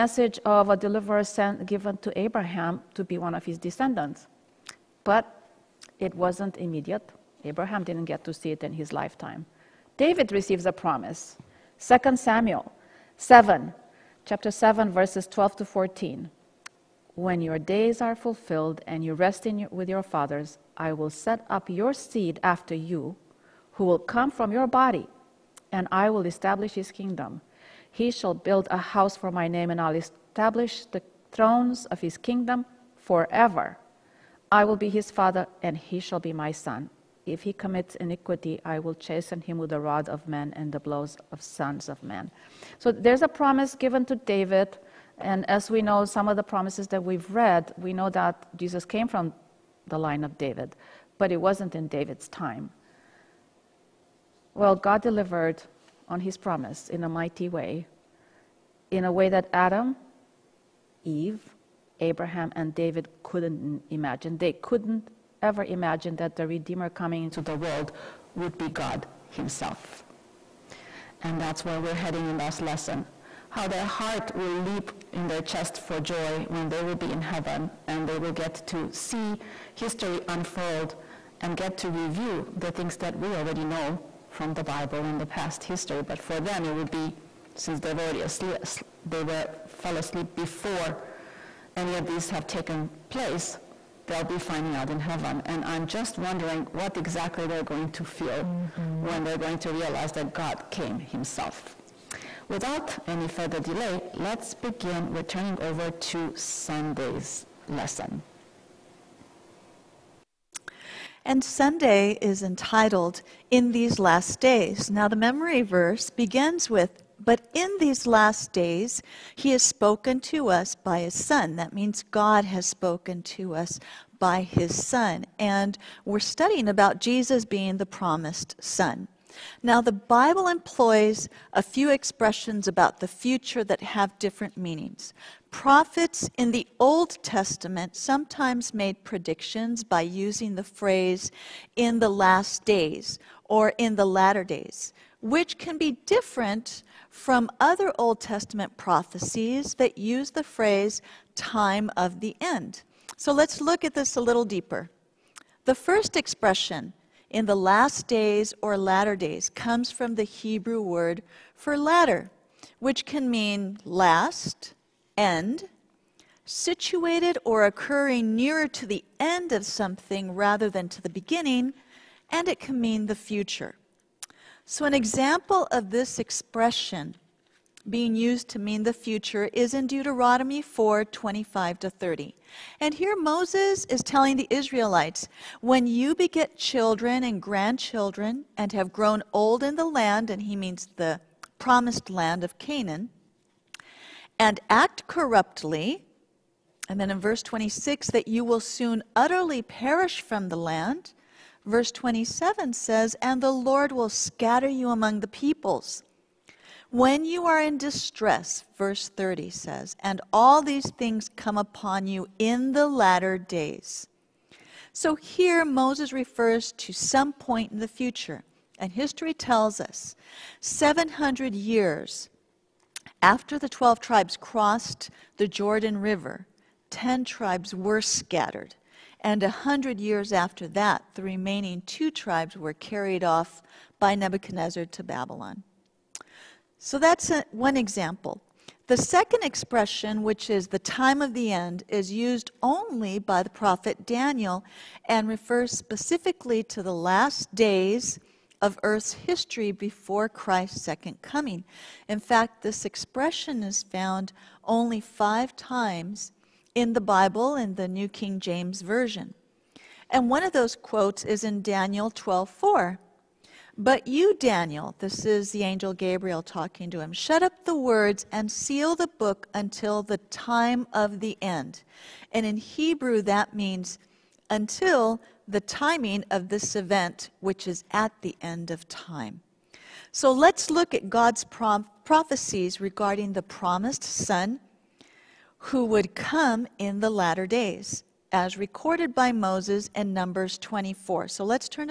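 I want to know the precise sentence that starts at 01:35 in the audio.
And I'm just wondering what exactly they're going to feel mm-hmm.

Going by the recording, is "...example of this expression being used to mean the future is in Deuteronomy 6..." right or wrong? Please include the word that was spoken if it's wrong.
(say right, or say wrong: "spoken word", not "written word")
wrong: "4", not "6".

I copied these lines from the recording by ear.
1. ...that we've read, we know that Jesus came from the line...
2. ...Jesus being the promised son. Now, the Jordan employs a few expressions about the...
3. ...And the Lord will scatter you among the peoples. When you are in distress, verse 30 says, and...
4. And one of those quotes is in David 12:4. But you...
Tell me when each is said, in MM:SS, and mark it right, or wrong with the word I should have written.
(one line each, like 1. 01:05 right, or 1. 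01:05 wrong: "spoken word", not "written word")
1. 00:46 right
2. 02:06 wrong: "Bible", not "Jordan"
3. 03:23 right
4. 04:20 wrong: "Daniel", not "David".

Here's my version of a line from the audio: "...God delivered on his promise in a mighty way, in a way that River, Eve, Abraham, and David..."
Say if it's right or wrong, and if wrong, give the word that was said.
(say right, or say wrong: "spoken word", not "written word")
wrong: "Adam", not "River".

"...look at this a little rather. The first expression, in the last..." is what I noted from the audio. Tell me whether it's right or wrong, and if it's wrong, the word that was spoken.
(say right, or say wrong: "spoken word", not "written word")
wrong: "deeper", not "rather".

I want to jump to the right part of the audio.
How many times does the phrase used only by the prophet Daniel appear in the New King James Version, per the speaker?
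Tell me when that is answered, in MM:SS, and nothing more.
04:14.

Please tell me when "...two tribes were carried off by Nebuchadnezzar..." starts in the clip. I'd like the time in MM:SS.
03:51.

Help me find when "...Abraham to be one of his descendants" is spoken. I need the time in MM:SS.
00:02.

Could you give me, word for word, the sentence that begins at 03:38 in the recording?
And history tells us 700 years after the 12 tribes crossed the Jordan River, 10 tribes were scattered.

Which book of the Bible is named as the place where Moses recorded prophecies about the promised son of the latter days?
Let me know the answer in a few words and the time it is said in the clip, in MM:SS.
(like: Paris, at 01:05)
Numbers, at 04:50.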